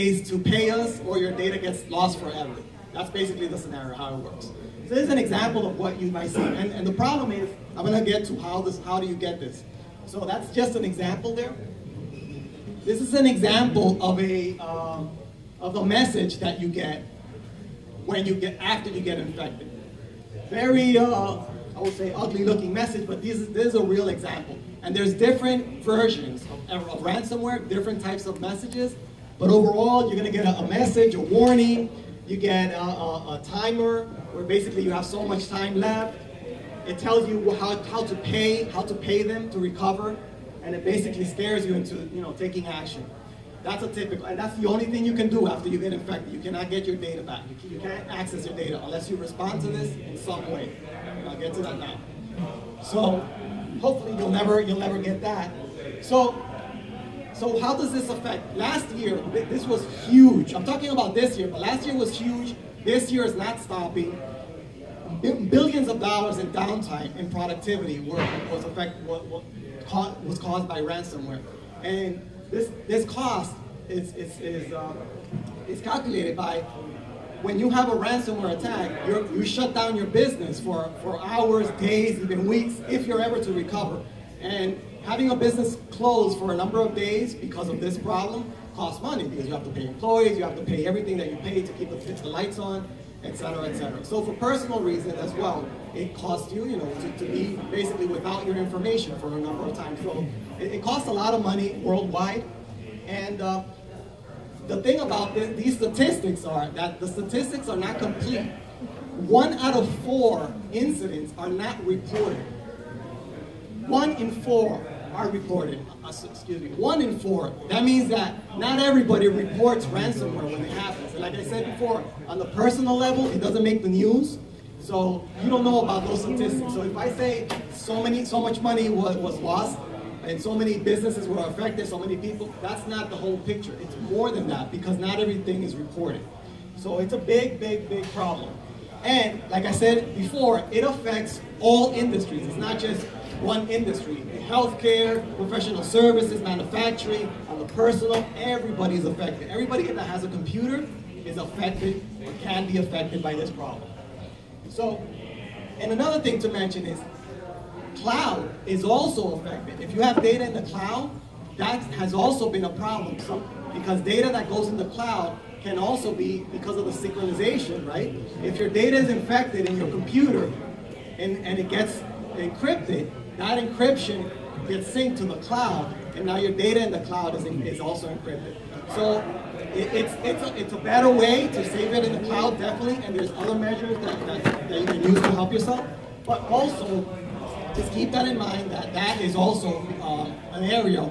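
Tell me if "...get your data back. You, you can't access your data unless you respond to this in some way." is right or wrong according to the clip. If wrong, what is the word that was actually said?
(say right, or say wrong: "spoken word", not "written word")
right.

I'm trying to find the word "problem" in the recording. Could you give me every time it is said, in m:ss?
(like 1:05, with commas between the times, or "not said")
0:06, 1:27, 2:18, 2:33, 2:42.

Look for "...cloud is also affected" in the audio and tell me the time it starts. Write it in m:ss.
2:38.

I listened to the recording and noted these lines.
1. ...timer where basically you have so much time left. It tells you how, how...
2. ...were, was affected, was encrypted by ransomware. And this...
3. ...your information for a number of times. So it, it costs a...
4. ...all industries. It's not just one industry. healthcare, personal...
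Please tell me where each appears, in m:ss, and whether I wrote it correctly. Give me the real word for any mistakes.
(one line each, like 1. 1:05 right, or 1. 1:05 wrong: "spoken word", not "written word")
1. 0:33 right
2. 1:08 wrong: "caused", not "encrypted"
3. 1:38 right
4. 2:21 wrong: "professional", not "personal".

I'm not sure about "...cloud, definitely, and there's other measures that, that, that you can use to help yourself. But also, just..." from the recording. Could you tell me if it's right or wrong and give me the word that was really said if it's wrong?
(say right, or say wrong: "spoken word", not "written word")
right.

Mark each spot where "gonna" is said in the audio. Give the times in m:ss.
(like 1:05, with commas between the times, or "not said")
0:07, 0:30.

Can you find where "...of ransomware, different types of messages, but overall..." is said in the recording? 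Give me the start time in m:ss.
0:26.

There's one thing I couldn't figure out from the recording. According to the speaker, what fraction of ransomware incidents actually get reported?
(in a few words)
1 in 4.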